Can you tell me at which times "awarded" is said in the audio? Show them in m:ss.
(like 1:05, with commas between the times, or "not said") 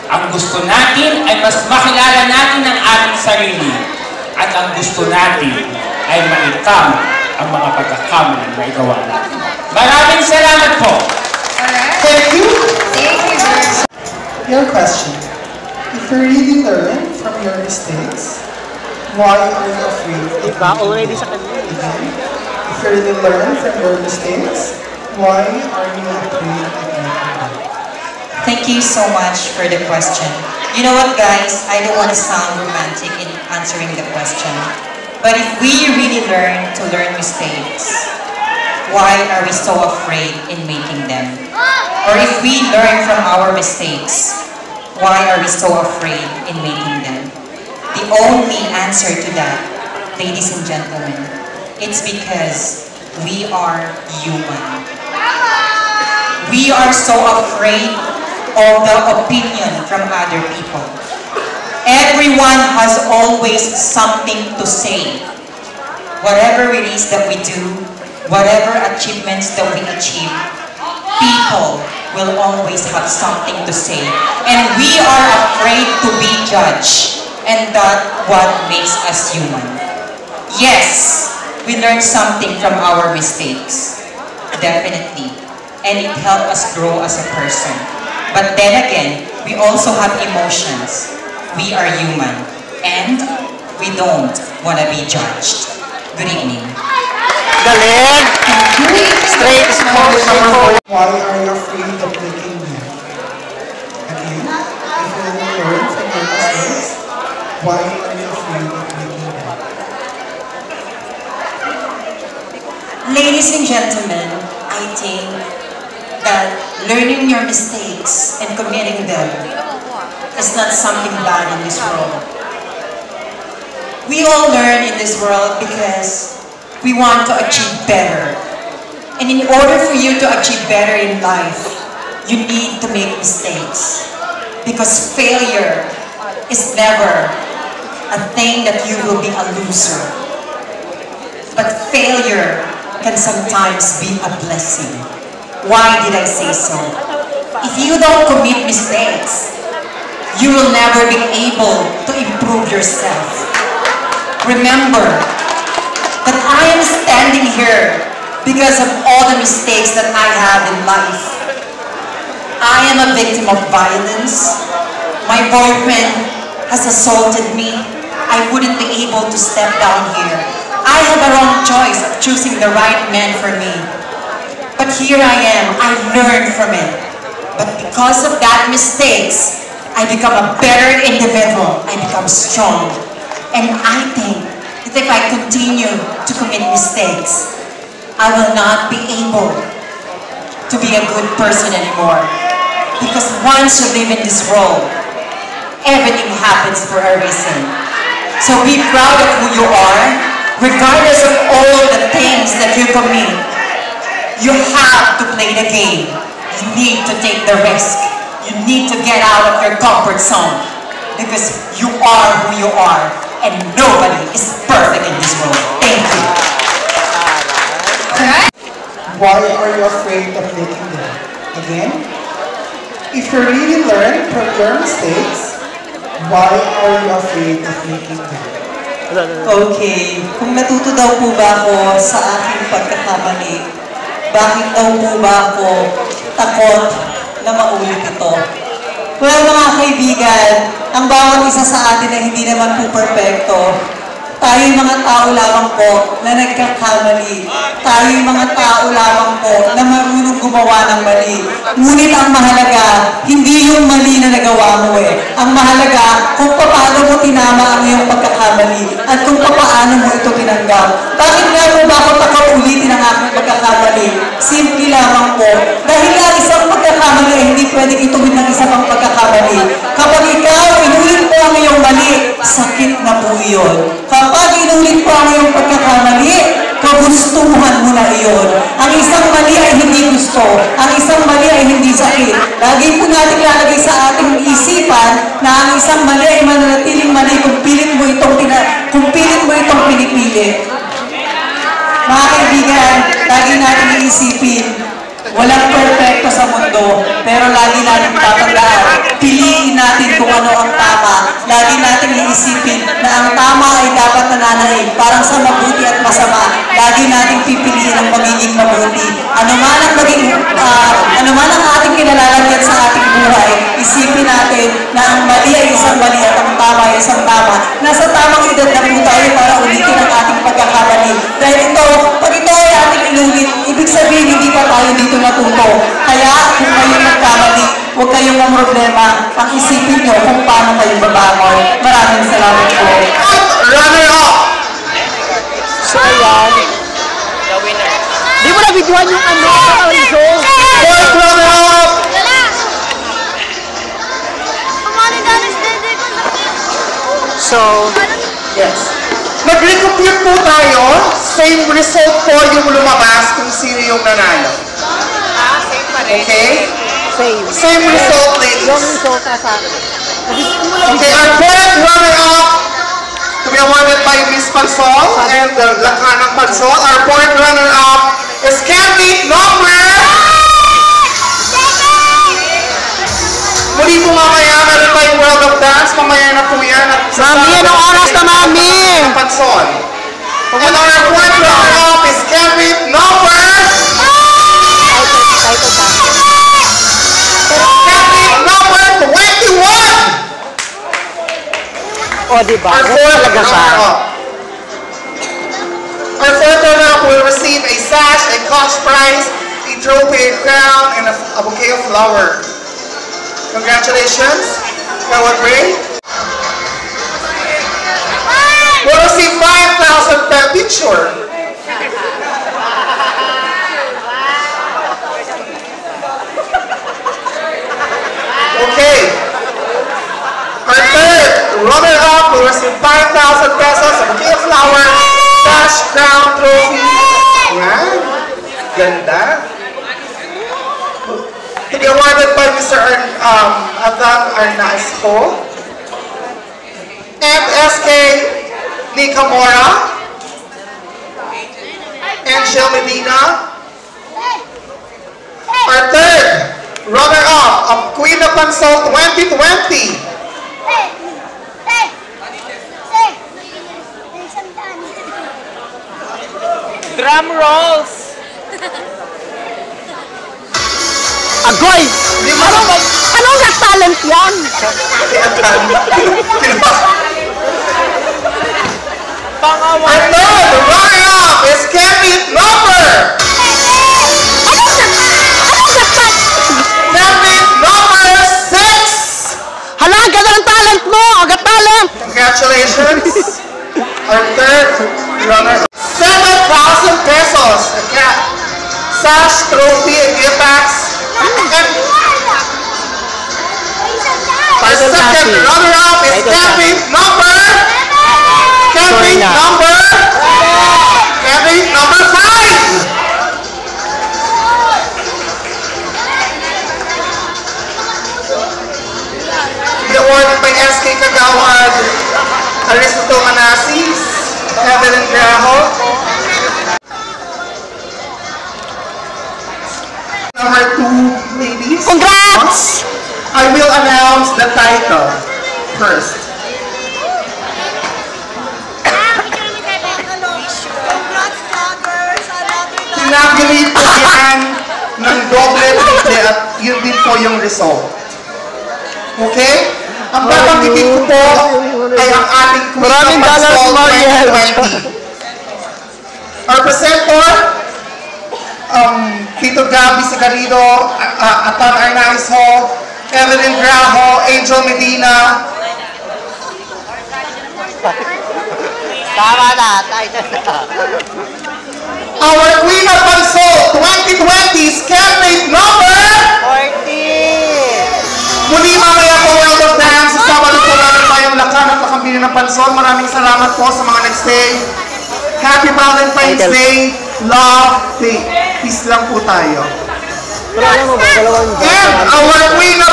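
6:03, 7:11, 8:29.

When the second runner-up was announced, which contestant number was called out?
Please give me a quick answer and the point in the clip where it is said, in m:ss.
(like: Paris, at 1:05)
5, at 8:21.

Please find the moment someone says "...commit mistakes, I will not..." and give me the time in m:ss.
3:06.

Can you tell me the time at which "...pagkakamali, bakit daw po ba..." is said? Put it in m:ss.
3:52.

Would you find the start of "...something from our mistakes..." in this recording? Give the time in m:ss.
1:21.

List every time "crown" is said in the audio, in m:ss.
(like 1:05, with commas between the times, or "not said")
6:40, 7:05.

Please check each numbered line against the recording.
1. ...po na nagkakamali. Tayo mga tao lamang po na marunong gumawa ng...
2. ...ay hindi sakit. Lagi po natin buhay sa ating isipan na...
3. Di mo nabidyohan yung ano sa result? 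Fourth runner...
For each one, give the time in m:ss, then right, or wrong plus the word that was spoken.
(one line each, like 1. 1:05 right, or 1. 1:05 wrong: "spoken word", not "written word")
1. 4:05 right
2. 4:41 wrong: "lalagay", not "buhay"
3. 5:38 right.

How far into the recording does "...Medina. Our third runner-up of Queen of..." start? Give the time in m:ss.
7:22.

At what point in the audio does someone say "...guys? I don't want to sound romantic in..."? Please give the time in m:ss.
0:31.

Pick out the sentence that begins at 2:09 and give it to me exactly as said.
And in order for you to achieve better in life, you need to make mistakes.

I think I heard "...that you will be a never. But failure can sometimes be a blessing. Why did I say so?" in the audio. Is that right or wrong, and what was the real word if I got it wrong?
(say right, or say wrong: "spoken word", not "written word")
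wrong: "loser", not "never".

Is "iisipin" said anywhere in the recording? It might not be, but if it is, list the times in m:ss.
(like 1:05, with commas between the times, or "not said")
4:54, 5:02.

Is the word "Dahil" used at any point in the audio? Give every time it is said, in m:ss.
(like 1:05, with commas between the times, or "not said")
4:25, 5:21.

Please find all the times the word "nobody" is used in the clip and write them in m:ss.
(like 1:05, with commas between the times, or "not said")
3:33.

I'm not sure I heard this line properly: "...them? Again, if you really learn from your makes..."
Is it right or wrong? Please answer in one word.
wrong.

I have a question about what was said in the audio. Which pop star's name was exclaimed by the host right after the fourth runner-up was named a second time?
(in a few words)
Michael Jackson.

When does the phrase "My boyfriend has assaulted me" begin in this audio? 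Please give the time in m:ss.
2:45.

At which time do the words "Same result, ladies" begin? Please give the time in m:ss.
5:57.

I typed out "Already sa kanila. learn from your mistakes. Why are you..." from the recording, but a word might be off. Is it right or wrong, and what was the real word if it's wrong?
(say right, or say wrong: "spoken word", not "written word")
right.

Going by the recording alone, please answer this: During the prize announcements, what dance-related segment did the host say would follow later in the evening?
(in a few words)
World of Dance.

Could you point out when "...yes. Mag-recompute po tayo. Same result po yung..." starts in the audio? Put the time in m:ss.
5:48.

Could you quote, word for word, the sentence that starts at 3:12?
Because once you live in this world, everything happens for a reason.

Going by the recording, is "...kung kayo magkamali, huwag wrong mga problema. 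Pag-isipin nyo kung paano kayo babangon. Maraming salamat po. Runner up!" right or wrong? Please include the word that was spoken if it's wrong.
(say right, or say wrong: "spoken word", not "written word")
wrong: "kayong", not "wrong".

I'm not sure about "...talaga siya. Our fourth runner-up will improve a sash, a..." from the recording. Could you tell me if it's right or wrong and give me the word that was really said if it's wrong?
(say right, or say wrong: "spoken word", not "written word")
wrong: "receive", not "improve".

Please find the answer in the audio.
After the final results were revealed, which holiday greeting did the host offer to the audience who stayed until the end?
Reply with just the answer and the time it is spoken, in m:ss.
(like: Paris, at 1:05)
Happy Valentine's Day, at 9:35.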